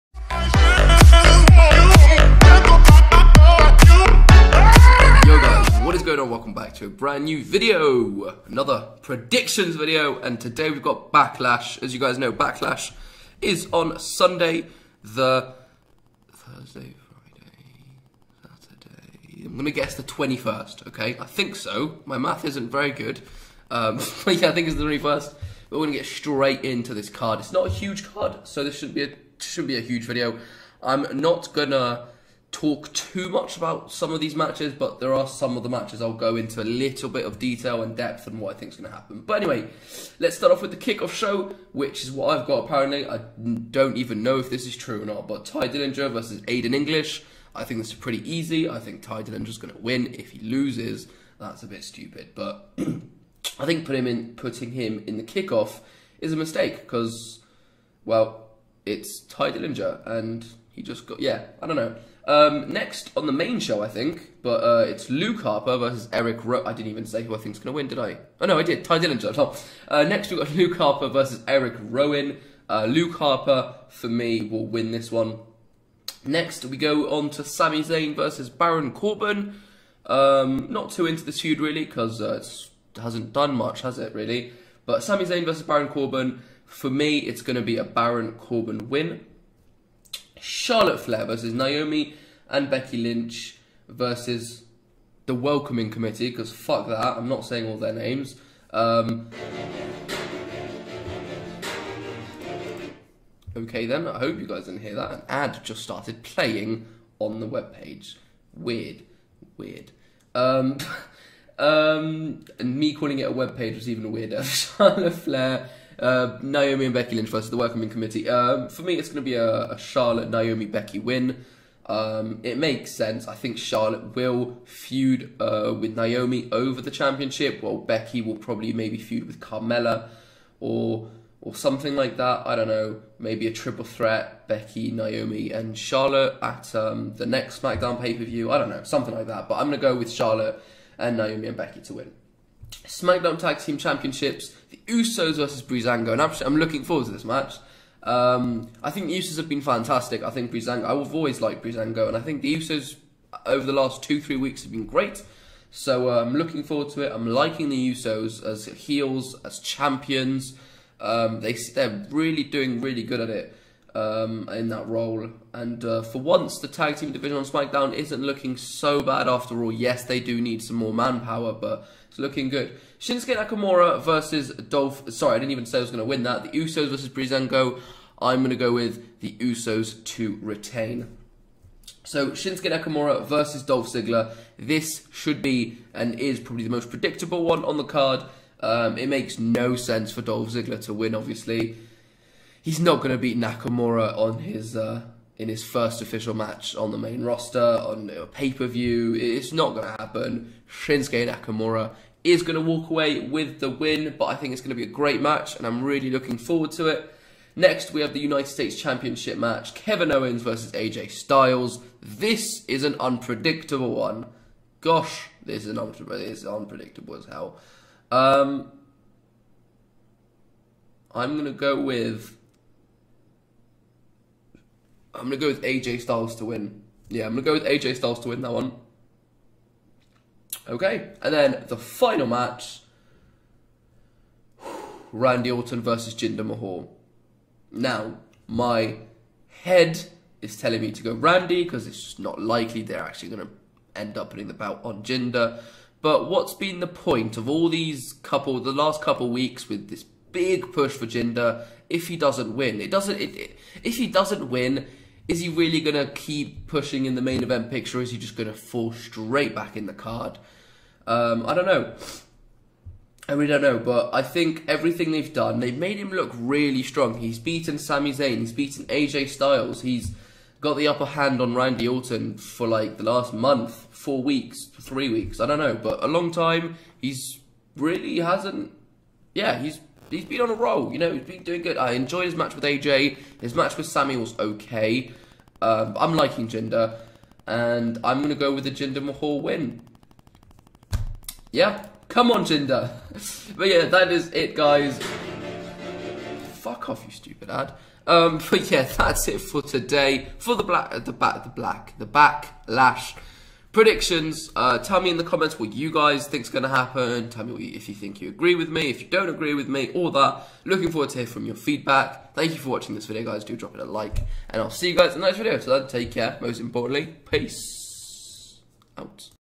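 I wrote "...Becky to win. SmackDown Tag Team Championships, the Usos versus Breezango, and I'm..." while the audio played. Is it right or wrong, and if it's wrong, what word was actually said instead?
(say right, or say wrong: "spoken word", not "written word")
right.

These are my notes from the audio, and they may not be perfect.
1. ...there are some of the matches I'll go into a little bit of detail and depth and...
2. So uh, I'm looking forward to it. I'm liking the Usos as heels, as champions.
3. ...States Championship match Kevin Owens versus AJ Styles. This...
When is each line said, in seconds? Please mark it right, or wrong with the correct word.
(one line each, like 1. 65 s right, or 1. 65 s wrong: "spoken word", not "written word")
1. 34 s right
2. 155 s right
3. 208 s right.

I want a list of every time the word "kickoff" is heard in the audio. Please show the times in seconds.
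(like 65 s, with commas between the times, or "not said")
40 s, 55 s.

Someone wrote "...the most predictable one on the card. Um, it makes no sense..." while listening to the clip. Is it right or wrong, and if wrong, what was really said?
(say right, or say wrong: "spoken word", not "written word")
right.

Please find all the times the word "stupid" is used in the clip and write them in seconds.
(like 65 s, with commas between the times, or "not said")
51 s, 297 s.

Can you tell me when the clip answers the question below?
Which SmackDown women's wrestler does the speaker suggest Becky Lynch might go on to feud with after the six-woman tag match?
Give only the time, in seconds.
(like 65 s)
129 s.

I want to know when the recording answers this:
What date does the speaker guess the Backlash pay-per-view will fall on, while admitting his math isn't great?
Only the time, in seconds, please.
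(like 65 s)
19 s.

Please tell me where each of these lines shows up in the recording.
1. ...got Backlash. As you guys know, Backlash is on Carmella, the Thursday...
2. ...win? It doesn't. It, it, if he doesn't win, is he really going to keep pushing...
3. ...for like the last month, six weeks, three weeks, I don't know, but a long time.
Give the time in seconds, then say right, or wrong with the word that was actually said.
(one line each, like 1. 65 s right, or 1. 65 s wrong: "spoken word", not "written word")
1. 10 s wrong: "Sunday", not "Carmella"
2. 252 s right
3. 272 s wrong: "four", not "six".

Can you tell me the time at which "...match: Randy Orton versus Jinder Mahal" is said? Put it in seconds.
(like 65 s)
232 s.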